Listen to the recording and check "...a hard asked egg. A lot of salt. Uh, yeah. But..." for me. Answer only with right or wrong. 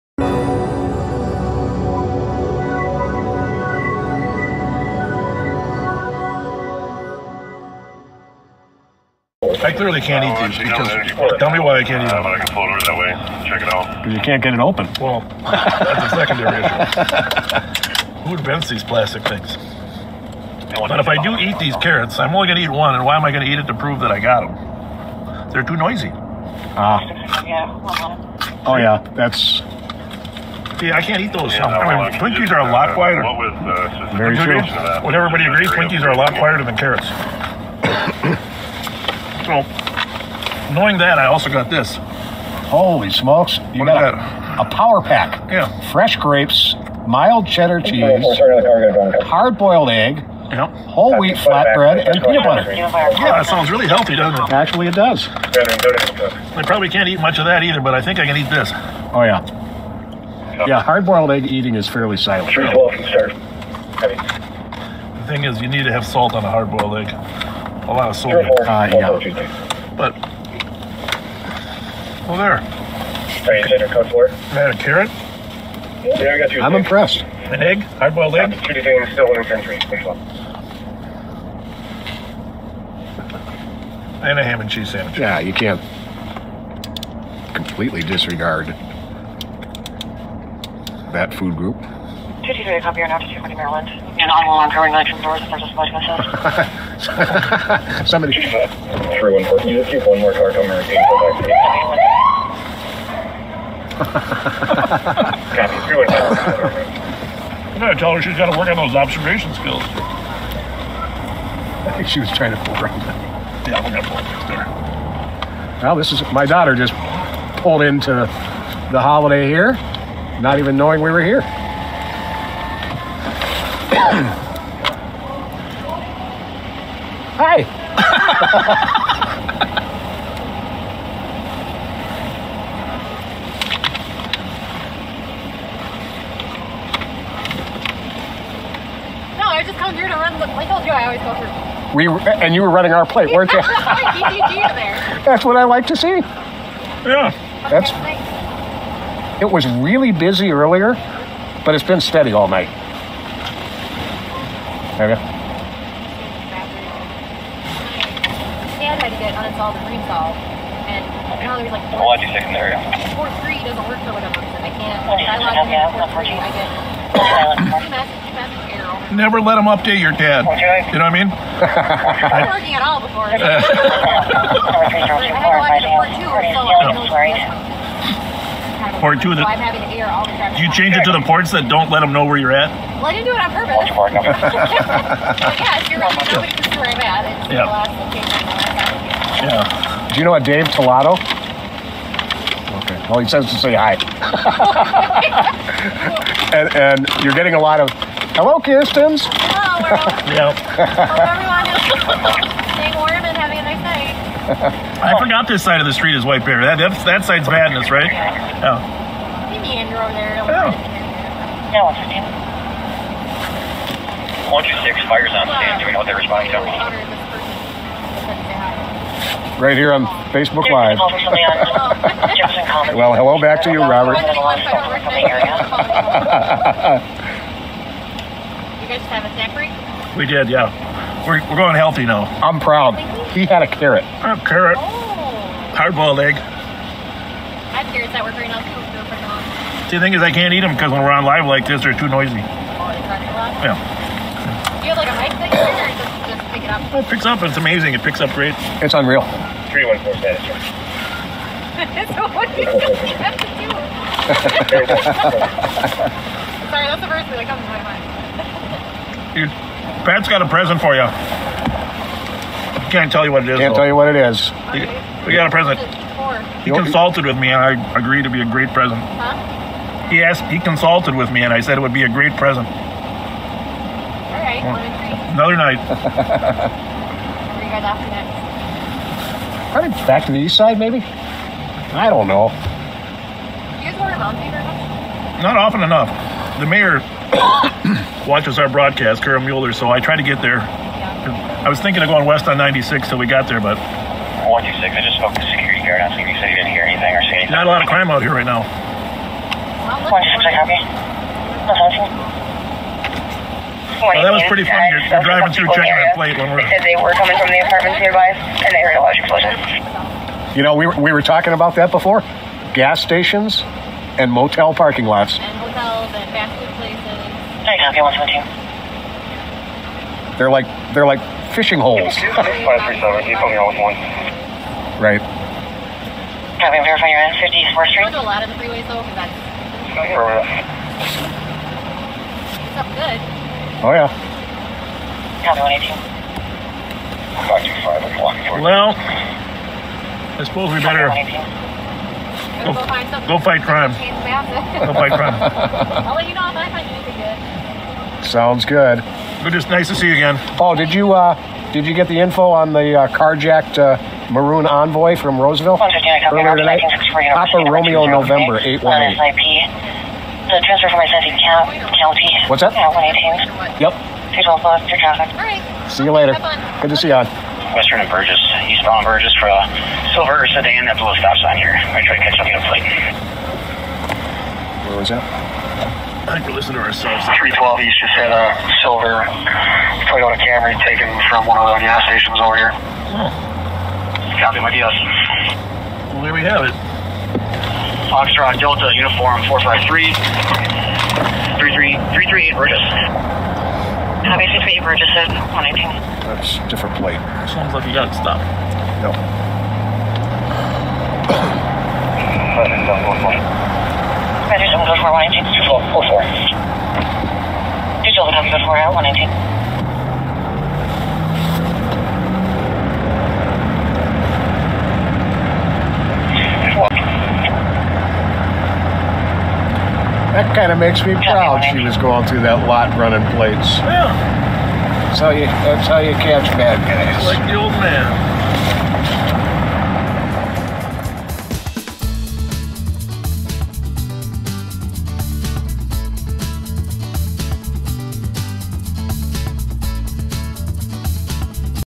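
wrong.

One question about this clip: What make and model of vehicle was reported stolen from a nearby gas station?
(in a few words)
Toyota Camry.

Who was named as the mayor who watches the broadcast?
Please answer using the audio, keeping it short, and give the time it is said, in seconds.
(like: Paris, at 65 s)
Carol Mueller, at 289 s.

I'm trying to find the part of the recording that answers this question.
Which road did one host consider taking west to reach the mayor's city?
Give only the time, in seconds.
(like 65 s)
292 s.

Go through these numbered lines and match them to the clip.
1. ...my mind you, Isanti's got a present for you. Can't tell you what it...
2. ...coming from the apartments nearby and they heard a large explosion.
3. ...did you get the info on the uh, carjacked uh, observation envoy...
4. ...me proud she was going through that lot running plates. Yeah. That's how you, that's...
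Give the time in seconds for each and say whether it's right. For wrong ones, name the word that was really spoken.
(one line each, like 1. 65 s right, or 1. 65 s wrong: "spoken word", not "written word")
1. 257 s wrong: "Pat", not "Isanti"
2. 307 s right
3. 351 s wrong: "maroon", not "observation"
4. 421 s right.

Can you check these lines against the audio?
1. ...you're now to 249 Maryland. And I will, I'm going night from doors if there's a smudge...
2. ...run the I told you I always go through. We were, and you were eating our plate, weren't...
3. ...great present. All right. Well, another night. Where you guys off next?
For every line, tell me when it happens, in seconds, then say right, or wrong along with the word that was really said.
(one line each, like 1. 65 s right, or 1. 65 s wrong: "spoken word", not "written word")
1. 92 s wrong: "240", not "249"
2. 140 s wrong: "running", not "eating"
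3. 272 s right.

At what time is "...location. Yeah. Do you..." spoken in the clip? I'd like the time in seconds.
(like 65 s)
187 s.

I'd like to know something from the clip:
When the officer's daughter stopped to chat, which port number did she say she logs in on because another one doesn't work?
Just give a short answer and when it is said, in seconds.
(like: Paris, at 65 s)
Four three, at 165 s.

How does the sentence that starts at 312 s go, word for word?
Gas stations and motel parking lots.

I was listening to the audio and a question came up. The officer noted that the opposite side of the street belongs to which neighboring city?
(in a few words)
White Bear.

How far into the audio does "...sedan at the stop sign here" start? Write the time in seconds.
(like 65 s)
370 s.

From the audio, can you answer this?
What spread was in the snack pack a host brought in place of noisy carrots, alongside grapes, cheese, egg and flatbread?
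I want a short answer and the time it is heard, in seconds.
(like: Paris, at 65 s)
Peanut butter, at 52 s.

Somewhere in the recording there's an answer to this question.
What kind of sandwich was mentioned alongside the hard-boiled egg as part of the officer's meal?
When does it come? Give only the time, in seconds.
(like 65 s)
84 s.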